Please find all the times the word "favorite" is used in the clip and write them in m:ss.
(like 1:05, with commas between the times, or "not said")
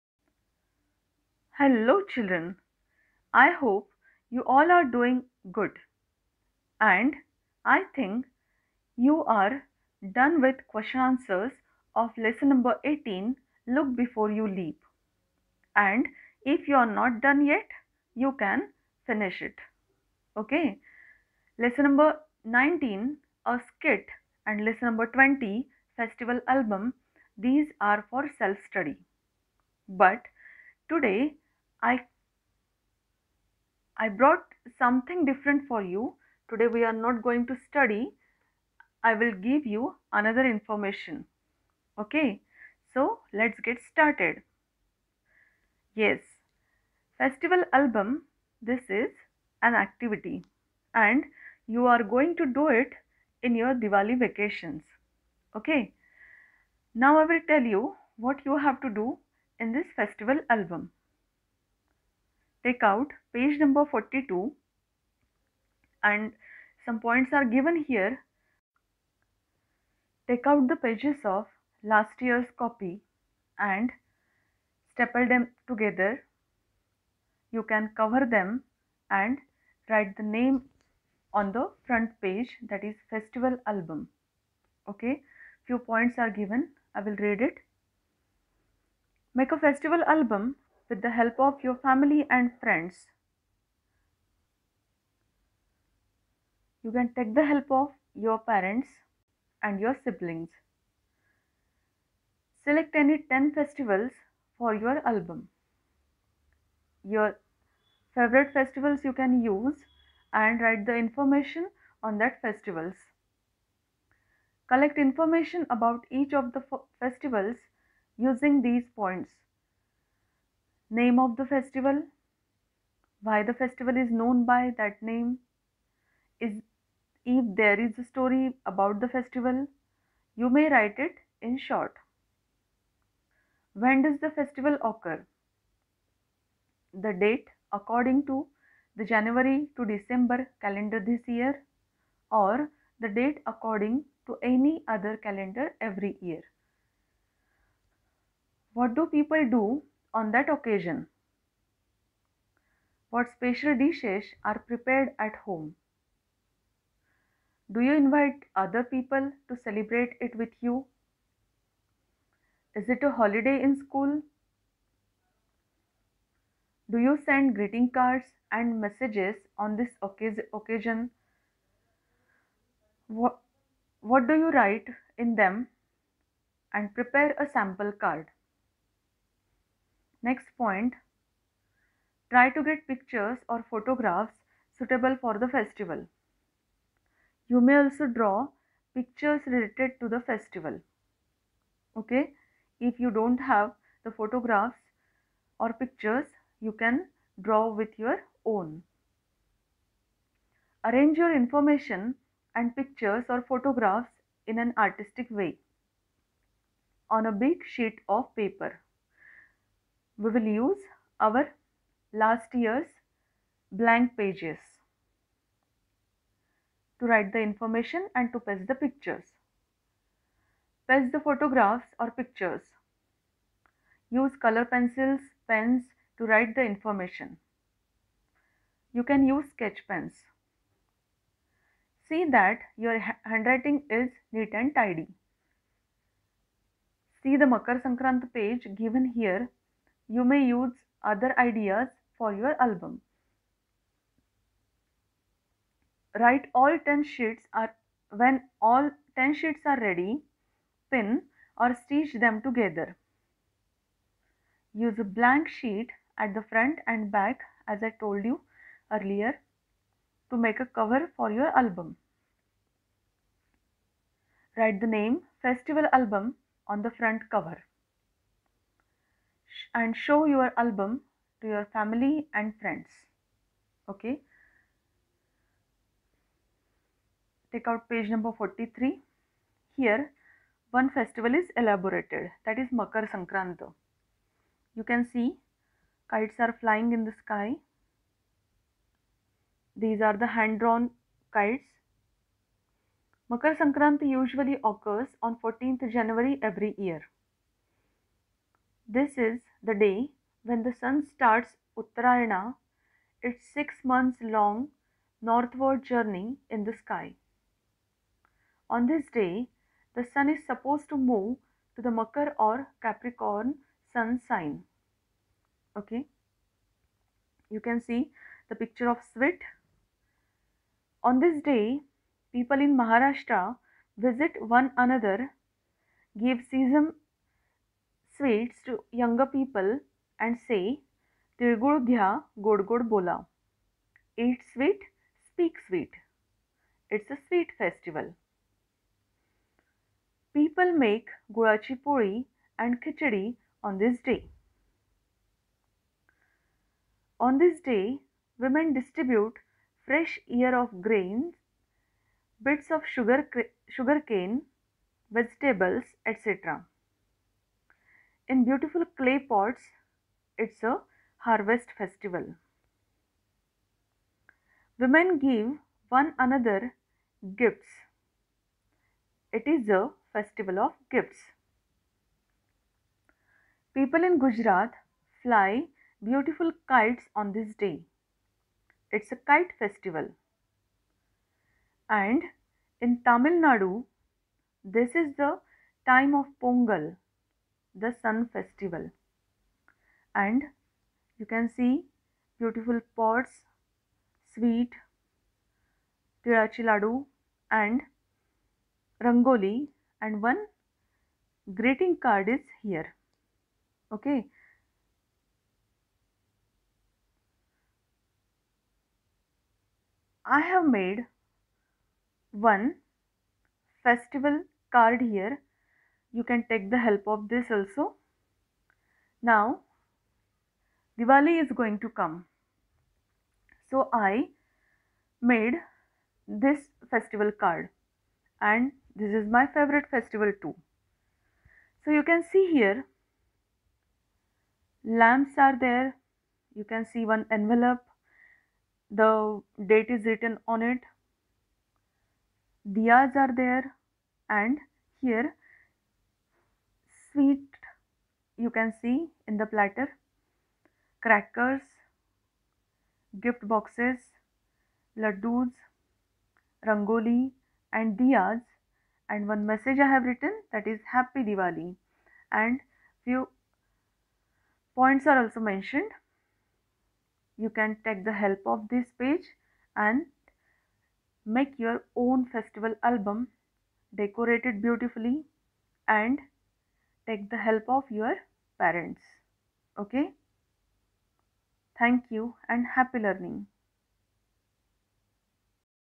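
1:48, 7:09.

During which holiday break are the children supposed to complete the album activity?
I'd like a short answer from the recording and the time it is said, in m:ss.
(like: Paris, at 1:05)
Diwali vacations, at 0:53.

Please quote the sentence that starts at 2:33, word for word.
What special dishes are prepared at home?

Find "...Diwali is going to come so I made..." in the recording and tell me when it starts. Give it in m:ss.
7:00.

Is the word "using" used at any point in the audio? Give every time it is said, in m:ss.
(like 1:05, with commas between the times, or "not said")
1:58.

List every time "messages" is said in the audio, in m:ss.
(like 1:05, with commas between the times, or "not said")
2:48, 7:39.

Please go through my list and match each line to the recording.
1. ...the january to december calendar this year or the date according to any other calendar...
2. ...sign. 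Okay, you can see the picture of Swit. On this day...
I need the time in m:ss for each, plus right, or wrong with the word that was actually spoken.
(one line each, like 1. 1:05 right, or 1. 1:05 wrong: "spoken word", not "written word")
1. 2:18 right
2. 5:14 right.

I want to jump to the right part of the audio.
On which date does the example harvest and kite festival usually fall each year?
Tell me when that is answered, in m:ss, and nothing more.
4:55.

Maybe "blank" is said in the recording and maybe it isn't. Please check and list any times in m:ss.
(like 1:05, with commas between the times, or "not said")
3:33, 4:15.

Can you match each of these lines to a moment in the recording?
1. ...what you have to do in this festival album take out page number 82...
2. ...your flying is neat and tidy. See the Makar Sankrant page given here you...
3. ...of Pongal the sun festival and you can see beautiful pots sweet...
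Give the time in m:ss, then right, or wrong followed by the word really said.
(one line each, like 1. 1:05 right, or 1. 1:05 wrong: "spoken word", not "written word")
1. 0:58 wrong: "42", not "82"
2. 3:52 wrong: "handwriting", not "flying"
3. 6:26 right.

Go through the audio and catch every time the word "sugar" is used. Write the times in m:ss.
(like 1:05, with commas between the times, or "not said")
5:52.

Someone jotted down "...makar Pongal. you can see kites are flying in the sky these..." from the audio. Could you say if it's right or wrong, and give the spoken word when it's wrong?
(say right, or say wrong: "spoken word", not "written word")
wrong: "Sankranti", not "Pongal".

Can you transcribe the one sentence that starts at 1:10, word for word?
Take out the pages of last year's copy and staple them together.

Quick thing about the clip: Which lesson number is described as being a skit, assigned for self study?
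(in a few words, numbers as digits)
19.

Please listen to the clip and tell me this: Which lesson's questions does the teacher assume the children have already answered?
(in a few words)
Look Before You Leap.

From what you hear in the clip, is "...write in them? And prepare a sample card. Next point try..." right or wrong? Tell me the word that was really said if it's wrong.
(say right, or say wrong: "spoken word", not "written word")
right.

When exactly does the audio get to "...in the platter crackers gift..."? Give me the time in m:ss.
7:29.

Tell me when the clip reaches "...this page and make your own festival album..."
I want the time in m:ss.
7:48.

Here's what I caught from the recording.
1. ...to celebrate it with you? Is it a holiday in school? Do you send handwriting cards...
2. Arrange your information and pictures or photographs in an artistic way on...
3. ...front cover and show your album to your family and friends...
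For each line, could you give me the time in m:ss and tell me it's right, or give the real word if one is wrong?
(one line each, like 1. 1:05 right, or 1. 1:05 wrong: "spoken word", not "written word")
1. 2:39 wrong: "greeting", not "handwriting"
2. 3:20 right
3. 4:26 right.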